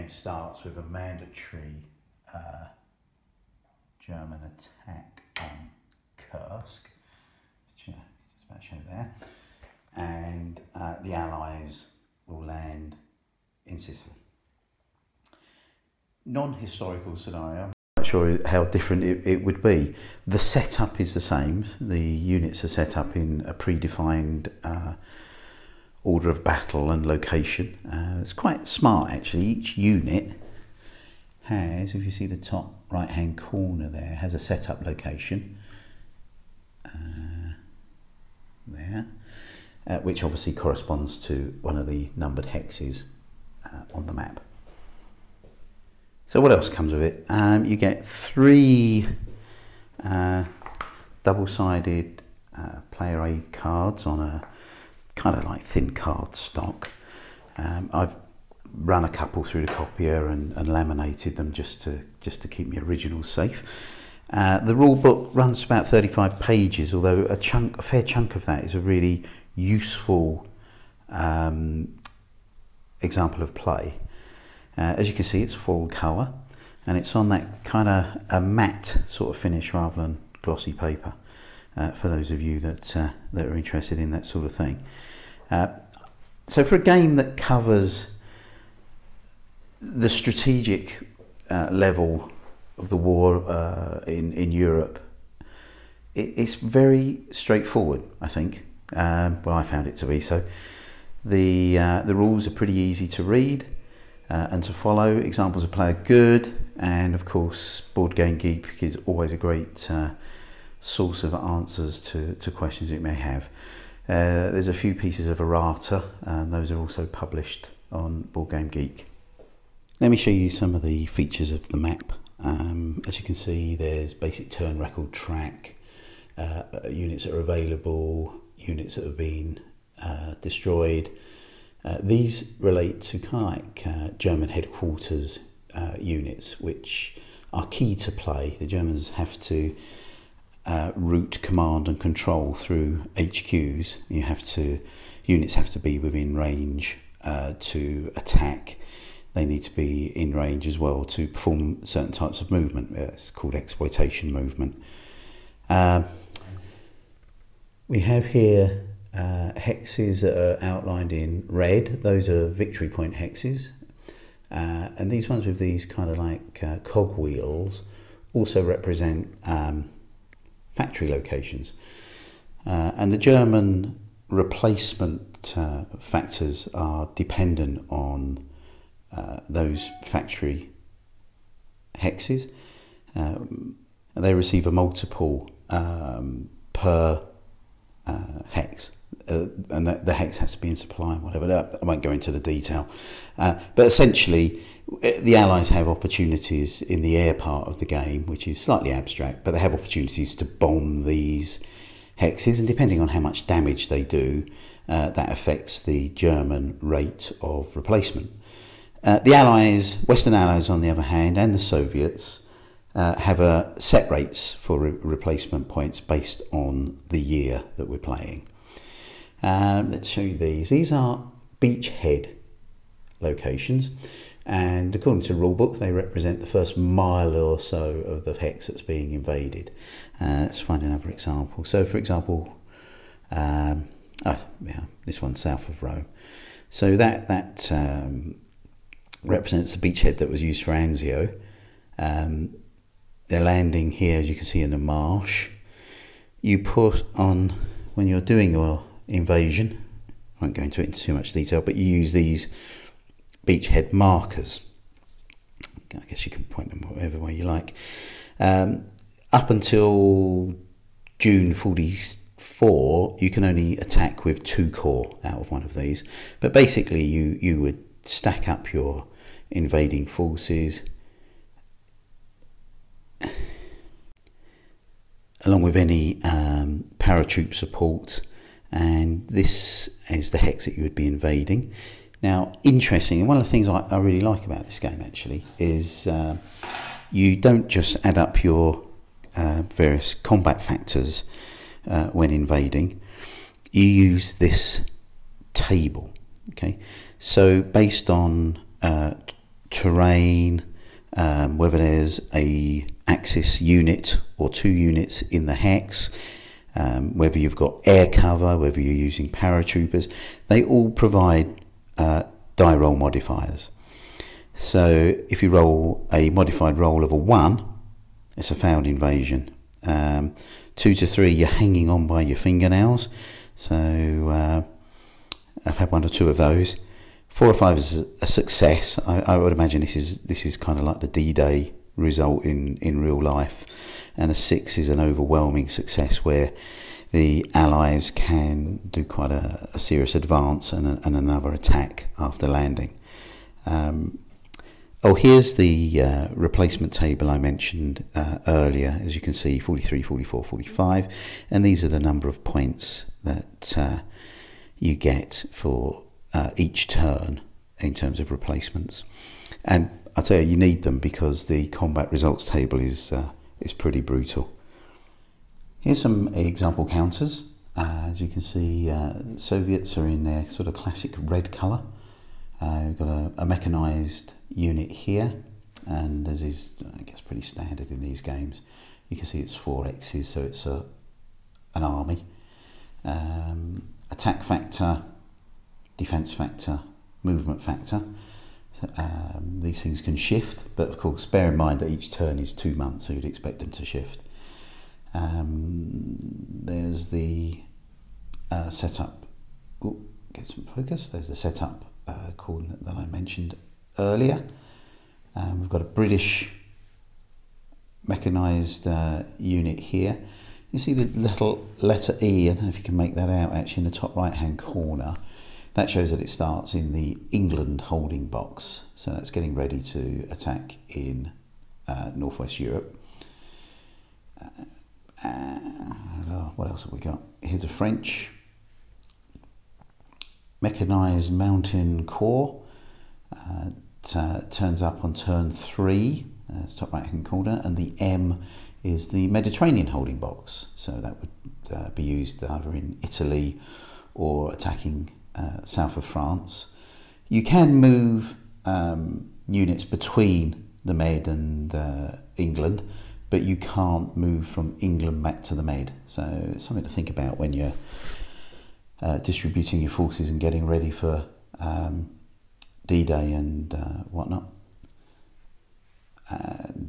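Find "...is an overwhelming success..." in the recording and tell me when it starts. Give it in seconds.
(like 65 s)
334 s.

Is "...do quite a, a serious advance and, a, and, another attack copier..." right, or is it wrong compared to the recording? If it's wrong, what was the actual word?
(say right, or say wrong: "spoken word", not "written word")
wrong: "after", not "copier".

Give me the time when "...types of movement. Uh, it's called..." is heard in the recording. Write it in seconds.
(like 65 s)
152 s.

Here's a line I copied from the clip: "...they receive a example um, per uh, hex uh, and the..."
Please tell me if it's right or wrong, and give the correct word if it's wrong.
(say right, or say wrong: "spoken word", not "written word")
wrong: "multiple", not "example".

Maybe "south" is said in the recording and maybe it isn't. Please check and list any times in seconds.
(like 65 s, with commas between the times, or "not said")
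235 s, 445 s.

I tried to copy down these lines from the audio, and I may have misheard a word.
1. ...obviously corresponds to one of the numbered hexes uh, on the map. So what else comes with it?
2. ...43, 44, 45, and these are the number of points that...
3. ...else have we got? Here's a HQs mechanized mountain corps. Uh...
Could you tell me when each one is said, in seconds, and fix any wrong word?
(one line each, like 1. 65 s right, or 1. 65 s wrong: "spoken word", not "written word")
1. 40 s right
2. 349 s right
3. 426 s wrong: "French", not "HQs".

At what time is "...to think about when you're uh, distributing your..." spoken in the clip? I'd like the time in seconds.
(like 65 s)
456 s.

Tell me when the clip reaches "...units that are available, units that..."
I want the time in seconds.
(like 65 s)
126 s.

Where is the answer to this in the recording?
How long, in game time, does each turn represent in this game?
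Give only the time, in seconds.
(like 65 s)
392 s.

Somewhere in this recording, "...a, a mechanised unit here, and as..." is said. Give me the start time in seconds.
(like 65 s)
373 s.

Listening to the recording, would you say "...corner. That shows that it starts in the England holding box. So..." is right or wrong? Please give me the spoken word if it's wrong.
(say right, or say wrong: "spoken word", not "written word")
right.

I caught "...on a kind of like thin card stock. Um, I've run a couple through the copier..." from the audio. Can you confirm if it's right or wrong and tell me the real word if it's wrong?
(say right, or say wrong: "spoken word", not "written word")
right.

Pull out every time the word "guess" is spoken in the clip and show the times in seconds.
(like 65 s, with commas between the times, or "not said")
256 s, 377 s.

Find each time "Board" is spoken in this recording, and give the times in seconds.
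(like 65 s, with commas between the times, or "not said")
107 s, 118 s.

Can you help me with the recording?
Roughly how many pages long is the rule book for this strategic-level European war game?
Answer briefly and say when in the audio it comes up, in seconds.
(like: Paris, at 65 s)
35, at 65 s.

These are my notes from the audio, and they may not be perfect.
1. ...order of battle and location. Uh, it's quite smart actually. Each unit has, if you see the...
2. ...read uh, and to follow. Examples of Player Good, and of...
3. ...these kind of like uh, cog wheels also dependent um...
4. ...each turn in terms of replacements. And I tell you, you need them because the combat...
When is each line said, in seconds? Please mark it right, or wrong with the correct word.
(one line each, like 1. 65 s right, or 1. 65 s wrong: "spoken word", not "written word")
1. 26 s right
2. 103 s right
3. 165 s wrong: "represent", not "dependent"
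4. 356 s right.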